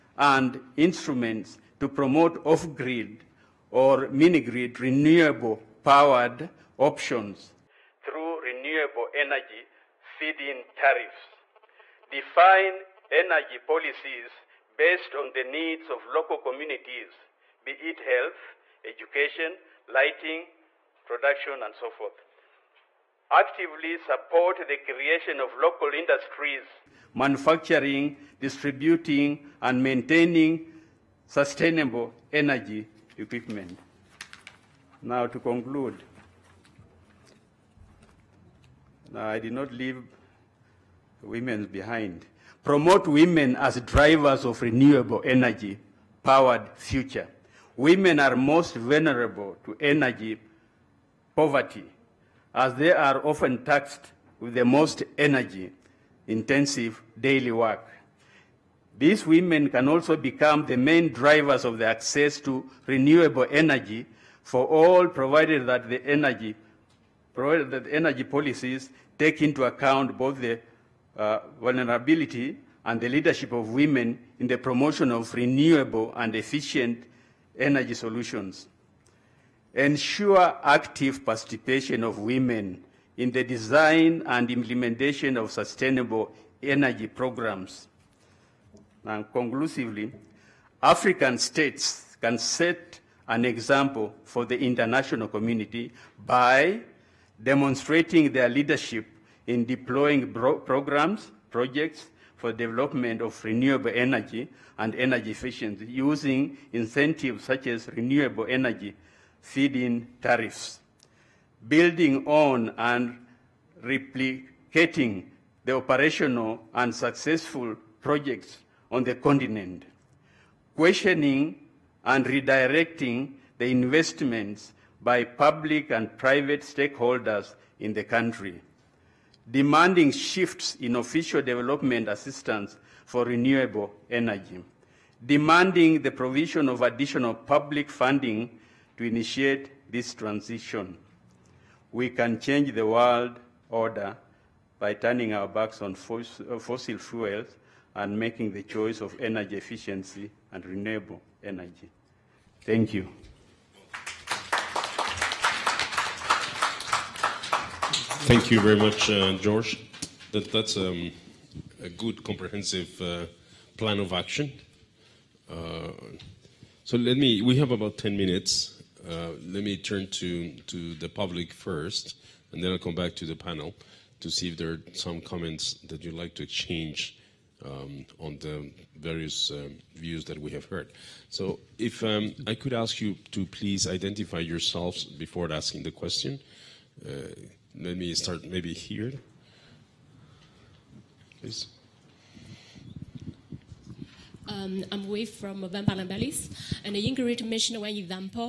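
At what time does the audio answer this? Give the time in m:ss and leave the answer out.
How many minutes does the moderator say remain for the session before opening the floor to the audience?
2:47.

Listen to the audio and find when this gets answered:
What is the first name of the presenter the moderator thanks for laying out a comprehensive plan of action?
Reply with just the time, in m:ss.
2:39.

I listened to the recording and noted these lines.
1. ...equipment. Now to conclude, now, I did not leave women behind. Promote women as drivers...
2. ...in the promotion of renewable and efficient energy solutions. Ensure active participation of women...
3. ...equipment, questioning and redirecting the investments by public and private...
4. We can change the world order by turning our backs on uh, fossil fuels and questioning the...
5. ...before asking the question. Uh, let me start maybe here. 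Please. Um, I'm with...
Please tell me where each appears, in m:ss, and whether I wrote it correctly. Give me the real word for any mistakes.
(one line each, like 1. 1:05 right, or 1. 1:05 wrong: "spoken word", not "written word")
1. 0:33 right
2. 1:14 right
3. 1:59 wrong: "continent", not "equipment"
4. 2:21 wrong: "making", not "questioning"
5. 3:05 right.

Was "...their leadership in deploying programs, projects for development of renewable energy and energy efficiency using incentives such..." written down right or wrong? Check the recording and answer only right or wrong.
right.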